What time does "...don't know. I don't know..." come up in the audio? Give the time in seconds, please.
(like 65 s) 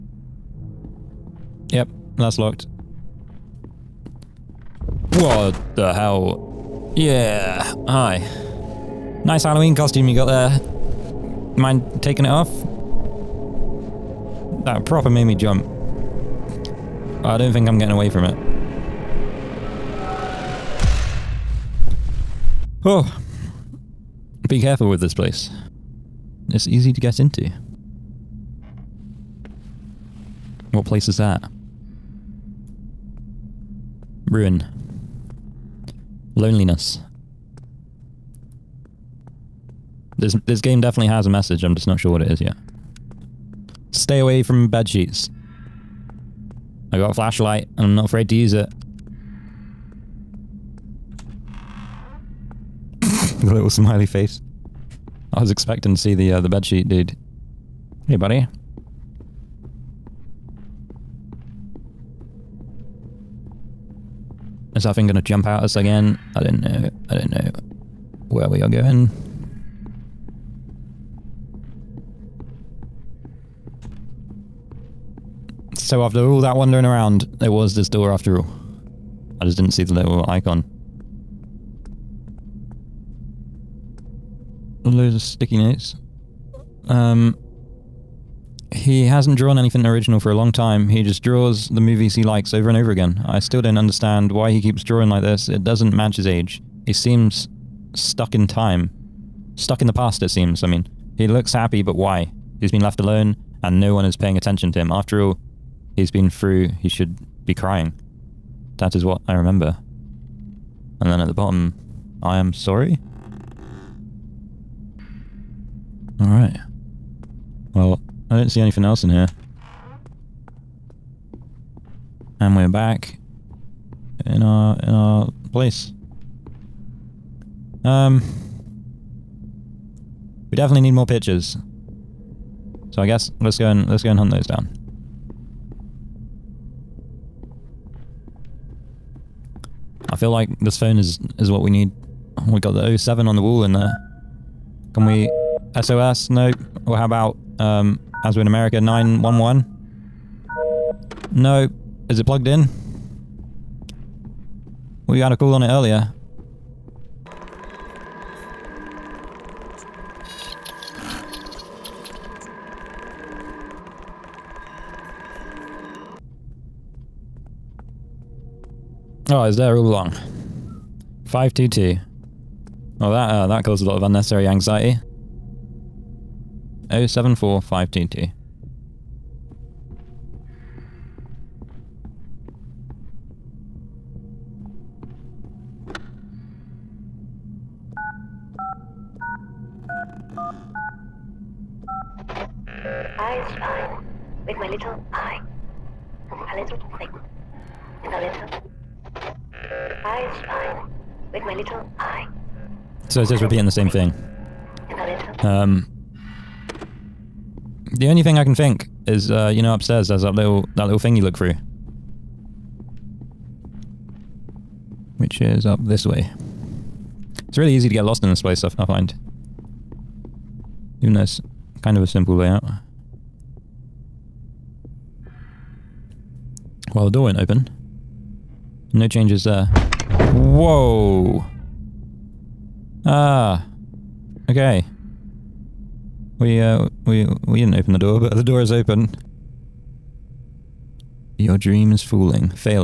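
66 s.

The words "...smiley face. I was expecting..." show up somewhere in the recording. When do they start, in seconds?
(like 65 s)
53 s.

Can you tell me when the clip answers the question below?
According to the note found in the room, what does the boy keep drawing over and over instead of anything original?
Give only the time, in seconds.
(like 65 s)
91 s.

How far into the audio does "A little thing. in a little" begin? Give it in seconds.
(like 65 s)
196 s.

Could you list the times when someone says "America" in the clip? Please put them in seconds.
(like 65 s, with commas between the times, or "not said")
148 s.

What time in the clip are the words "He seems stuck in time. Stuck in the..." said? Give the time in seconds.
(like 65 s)
96 s.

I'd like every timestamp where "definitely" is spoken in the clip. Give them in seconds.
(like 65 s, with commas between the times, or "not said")
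40 s, 130 s.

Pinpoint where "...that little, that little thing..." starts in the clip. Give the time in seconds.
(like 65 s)
210 s.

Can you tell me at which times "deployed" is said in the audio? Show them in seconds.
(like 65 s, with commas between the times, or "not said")
not said.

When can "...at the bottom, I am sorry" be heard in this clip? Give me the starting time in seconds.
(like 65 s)
111 s.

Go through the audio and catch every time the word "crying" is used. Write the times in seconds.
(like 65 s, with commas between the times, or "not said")
107 s.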